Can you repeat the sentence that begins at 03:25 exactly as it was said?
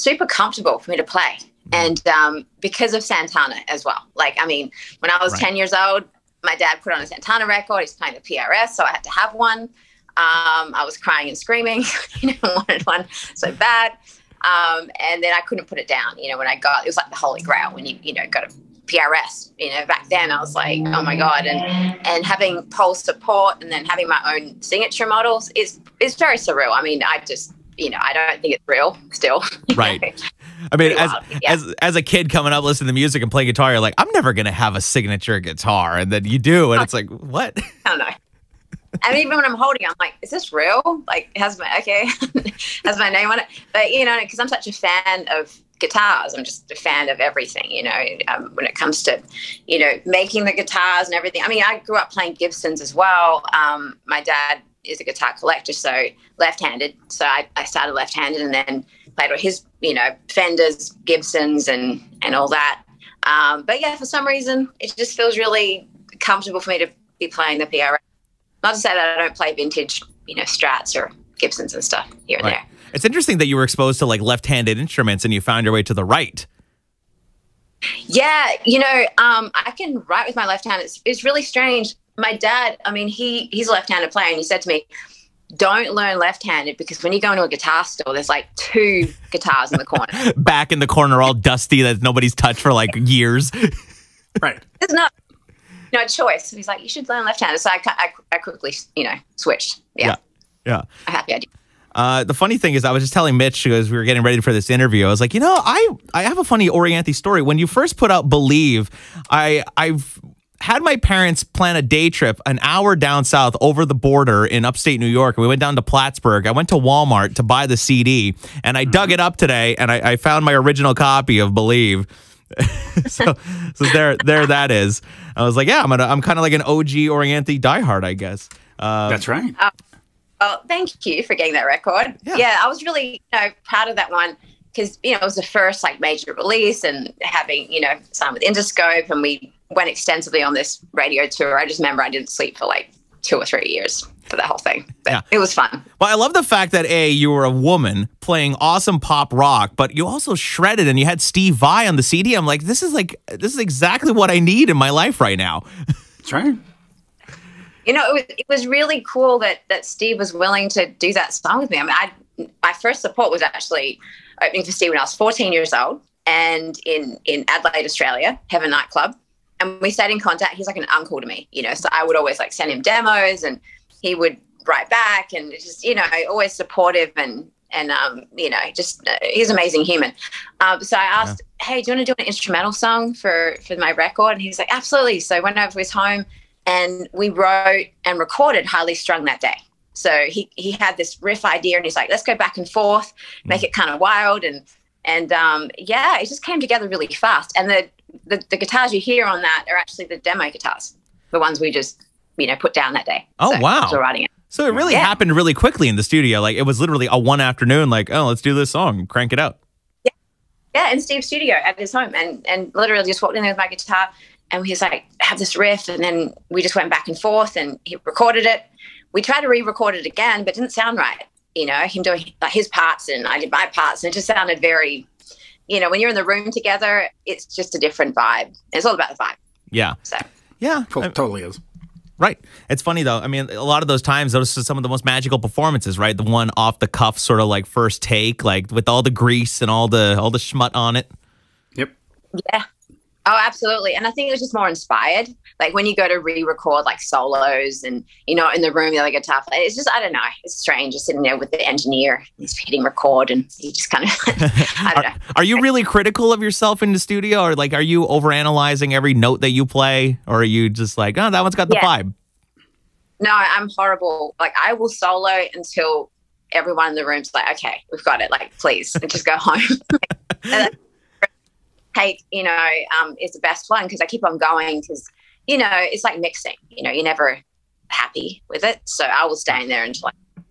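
happened really quickly in the studio.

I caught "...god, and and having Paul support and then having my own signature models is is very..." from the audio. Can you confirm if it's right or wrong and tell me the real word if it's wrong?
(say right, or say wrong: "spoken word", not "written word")
right.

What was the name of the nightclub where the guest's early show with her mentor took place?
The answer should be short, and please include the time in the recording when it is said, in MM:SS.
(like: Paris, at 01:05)
Heaven Nightclub, at 02:48.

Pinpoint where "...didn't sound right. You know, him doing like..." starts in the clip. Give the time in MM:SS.
03:40.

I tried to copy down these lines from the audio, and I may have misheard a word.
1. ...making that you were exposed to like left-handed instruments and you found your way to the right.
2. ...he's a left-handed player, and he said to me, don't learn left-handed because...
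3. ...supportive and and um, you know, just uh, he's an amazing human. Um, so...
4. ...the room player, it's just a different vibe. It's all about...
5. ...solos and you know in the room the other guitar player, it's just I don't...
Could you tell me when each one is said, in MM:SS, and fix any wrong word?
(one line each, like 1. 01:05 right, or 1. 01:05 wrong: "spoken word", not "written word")
1. 01:13 wrong: "interesting", not "making"
2. 01:23 right
3. 02:56 right
4. 03:46 wrong: "together", not "player"
5. 04:07 right.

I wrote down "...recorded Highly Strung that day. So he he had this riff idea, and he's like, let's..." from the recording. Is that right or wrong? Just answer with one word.
right.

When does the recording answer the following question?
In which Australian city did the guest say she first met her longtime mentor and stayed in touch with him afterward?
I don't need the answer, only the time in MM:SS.
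02:47.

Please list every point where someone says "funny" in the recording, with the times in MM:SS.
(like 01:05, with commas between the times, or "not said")
01:42, 01:46, 03:52.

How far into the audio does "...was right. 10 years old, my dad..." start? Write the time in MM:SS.
00:05.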